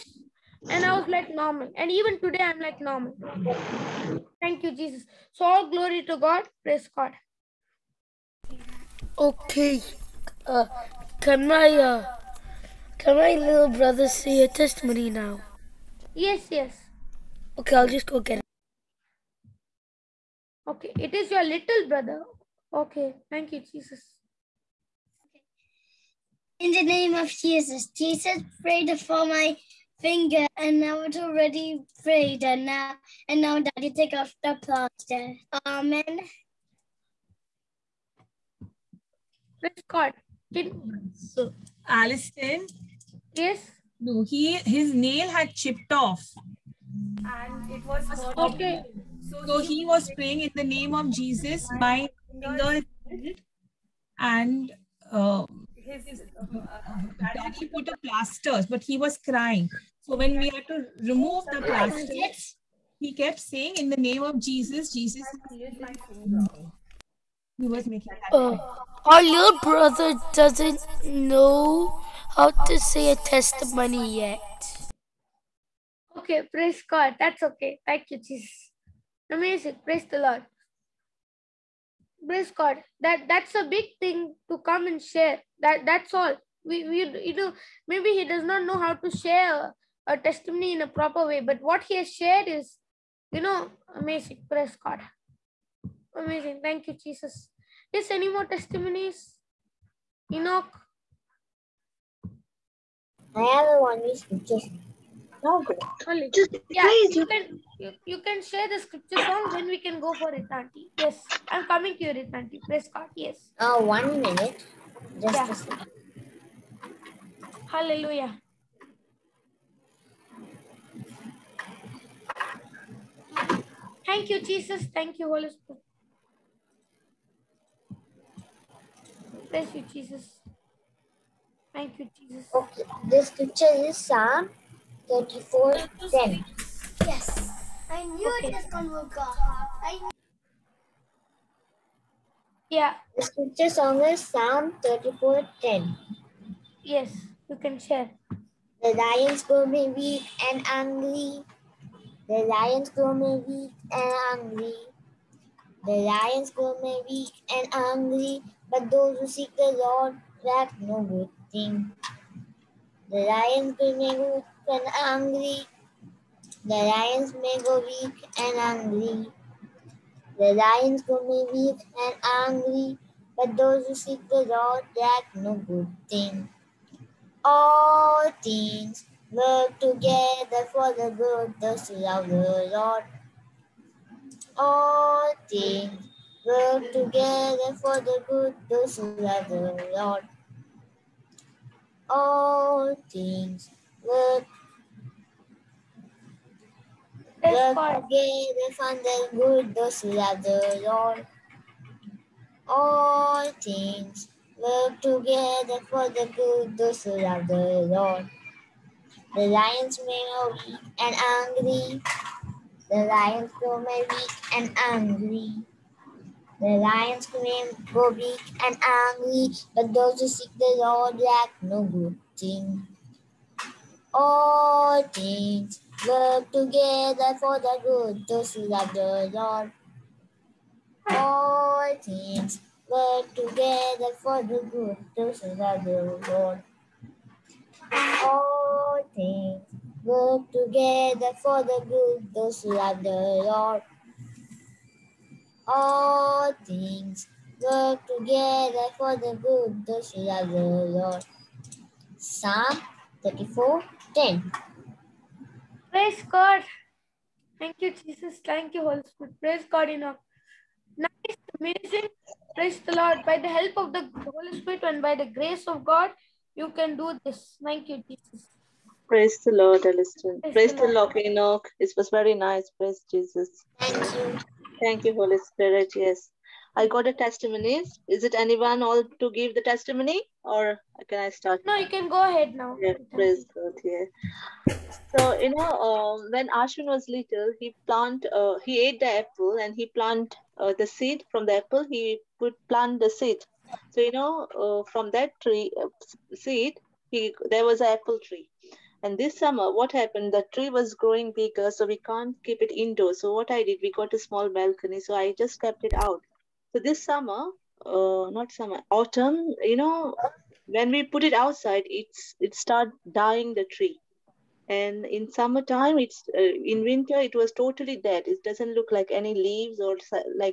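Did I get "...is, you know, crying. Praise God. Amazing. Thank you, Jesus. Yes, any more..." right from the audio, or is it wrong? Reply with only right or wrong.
wrong.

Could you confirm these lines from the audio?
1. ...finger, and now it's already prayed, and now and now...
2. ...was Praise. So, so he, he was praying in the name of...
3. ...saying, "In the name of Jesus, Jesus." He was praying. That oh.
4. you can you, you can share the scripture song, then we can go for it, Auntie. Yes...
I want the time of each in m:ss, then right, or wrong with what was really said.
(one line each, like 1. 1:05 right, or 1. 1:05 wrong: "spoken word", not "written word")
1. 0:30 right
2. 0:47 wrong: "Okay", not "Praise"
3. 1:03 wrong: "making", not "praying"
4. 1:47 right.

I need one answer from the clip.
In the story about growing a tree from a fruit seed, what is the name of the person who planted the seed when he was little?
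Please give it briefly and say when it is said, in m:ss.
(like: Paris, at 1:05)
Ashwin, at 4:46.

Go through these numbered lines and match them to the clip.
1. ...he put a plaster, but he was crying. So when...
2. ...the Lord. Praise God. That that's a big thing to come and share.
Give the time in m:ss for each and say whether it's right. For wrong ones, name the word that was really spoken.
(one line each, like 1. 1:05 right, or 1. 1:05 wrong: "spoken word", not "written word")
1. 0:57 right
2. 1:20 right.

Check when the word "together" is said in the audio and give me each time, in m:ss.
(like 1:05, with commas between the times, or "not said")
2:59, 3:06, 3:17, 3:25, 3:46, 3:53, 4:00, 4:08.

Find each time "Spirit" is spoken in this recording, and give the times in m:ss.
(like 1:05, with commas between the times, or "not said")
2:05, 4:19, 4:24, 4:35.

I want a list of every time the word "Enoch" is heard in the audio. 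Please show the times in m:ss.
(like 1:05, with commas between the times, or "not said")
1:40, 4:31.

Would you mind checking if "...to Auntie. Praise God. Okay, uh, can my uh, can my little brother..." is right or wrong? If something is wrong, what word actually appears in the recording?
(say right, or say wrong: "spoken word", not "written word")
wrong: "God", not "Auntie".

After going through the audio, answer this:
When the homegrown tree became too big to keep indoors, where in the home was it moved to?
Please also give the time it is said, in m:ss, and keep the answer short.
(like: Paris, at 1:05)
A small balcony, at 5:04.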